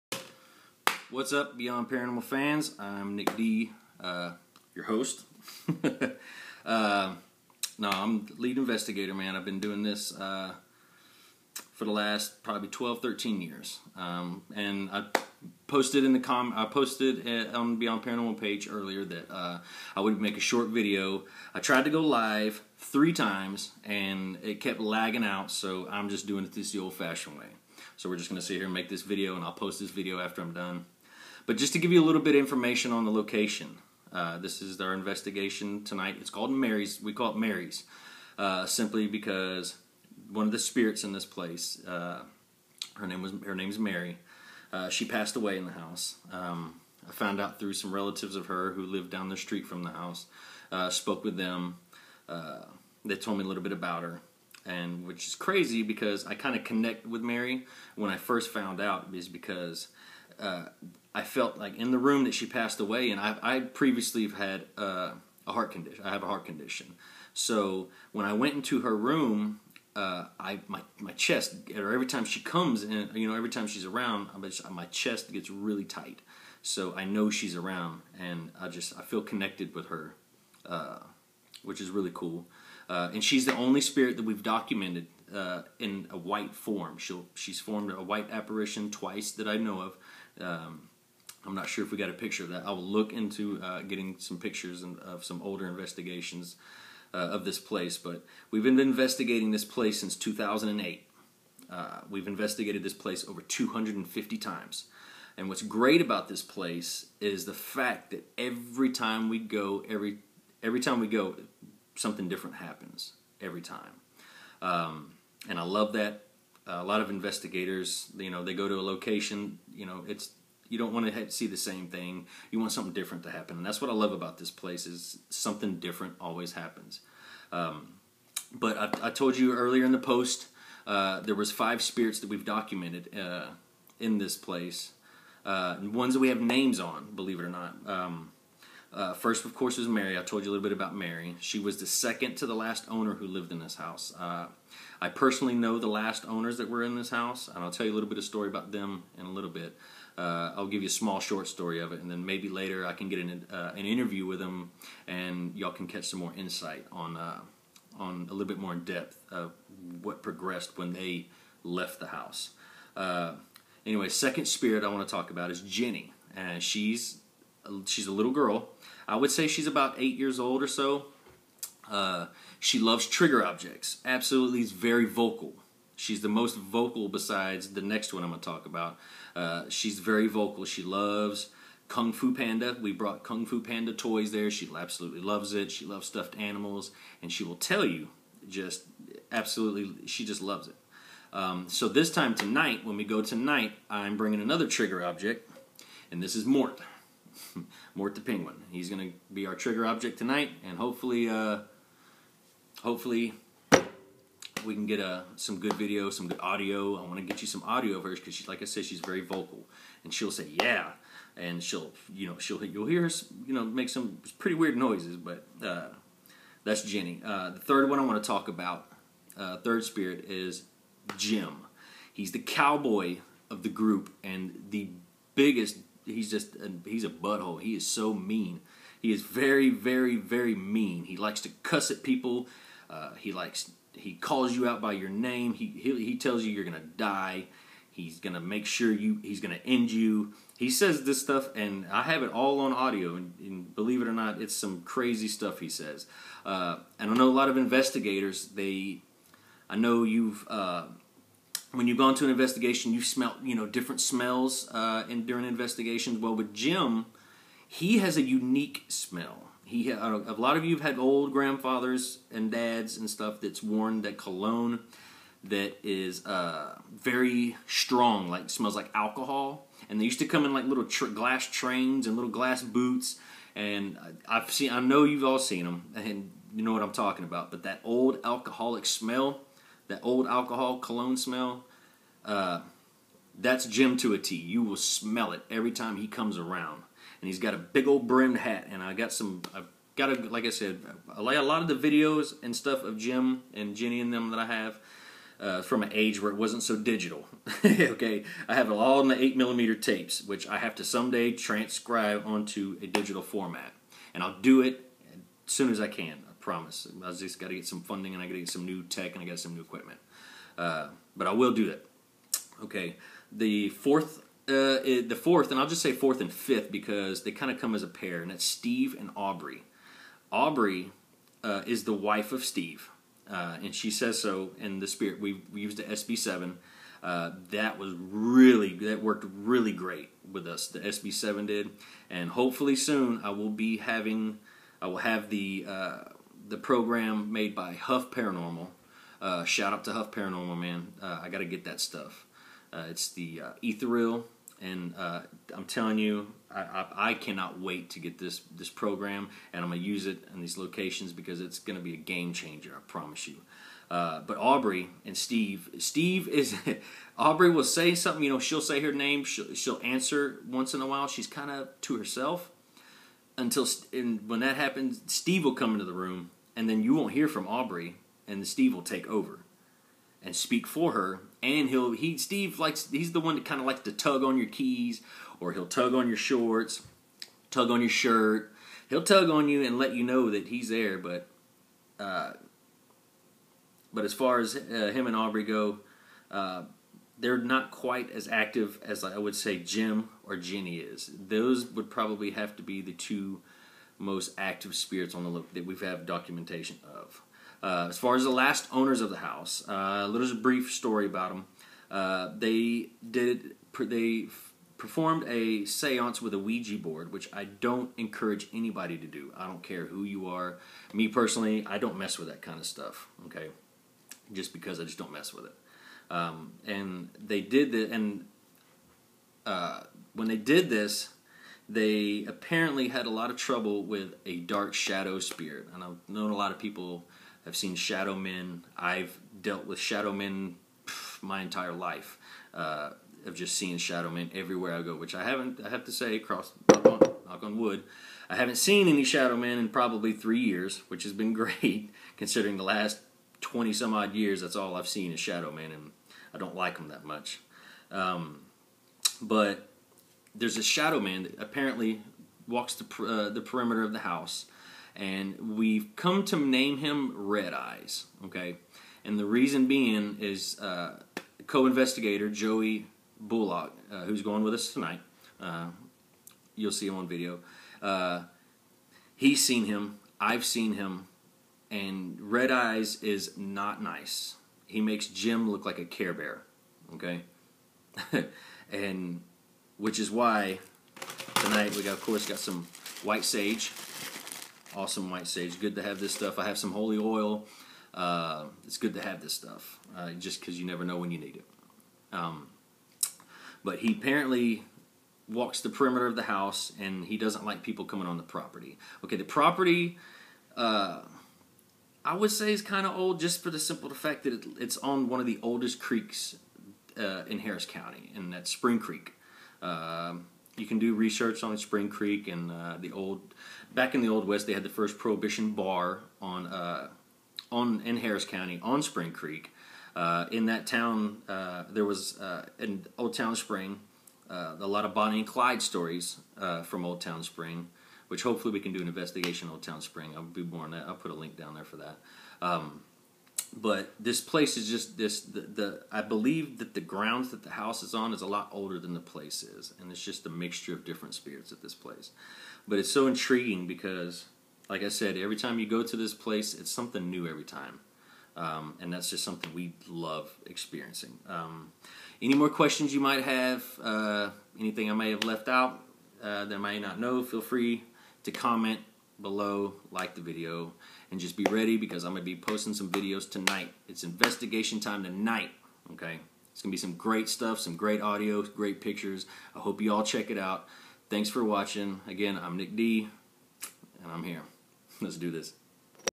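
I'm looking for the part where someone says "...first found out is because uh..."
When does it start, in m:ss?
0:58.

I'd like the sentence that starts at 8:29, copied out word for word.
Uh, you can do research on Spring Creek and uh, the old.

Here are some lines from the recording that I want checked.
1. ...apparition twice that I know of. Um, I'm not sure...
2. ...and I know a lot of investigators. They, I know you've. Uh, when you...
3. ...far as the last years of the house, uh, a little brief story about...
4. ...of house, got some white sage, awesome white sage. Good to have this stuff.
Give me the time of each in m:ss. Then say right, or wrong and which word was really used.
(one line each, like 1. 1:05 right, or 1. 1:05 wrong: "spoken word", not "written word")
1. 1:28 right
2. 4:06 right
3. 6:37 wrong: "owners", not "years"
4. 8:01 wrong: "course", not "house".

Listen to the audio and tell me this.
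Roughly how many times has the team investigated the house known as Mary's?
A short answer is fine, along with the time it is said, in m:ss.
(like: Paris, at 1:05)
over 250, at 1:43.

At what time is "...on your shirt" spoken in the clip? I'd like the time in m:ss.
6:17.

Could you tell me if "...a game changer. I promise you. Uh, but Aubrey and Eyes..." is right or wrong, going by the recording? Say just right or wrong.
wrong.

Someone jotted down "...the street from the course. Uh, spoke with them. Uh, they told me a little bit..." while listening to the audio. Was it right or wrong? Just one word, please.
wrong.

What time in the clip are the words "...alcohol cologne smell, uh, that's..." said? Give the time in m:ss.
4:40.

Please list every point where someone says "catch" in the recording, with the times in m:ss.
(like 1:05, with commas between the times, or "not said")
2:35.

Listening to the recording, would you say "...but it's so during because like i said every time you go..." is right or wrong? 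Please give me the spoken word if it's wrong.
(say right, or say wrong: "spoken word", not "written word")
wrong: "intriguing", not "during".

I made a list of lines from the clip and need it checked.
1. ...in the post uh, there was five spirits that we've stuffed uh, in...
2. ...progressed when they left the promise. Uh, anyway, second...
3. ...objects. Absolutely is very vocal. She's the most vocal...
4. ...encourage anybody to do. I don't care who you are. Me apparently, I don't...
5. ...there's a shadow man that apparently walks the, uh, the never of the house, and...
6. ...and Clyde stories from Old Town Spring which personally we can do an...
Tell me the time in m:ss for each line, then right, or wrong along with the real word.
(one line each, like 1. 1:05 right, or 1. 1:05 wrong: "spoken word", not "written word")
1. 2:09 wrong: "documented", not "stuffed"
2. 2:40 wrong: "house", not "promise"
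3. 2:53 right
4. 6:47 wrong: "personally", not "apparently"
5. 7:30 wrong: "perimeter", not "never"
6. 8:45 wrong: "hopefully", not "personally".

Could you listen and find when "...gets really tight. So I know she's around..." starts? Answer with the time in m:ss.
1:15.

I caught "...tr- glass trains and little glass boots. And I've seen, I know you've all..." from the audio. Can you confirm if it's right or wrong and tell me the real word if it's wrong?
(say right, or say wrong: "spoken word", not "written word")
right.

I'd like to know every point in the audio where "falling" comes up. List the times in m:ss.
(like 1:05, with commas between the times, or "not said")
not said.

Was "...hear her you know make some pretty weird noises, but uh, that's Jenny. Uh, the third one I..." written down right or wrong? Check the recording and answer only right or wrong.
right.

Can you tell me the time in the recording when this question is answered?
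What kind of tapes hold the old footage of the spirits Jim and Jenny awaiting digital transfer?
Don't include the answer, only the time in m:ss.
4:59.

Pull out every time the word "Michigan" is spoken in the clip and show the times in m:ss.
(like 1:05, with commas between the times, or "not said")
not said.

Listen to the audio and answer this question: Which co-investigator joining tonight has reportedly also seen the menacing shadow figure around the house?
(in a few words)
Joey Bullock.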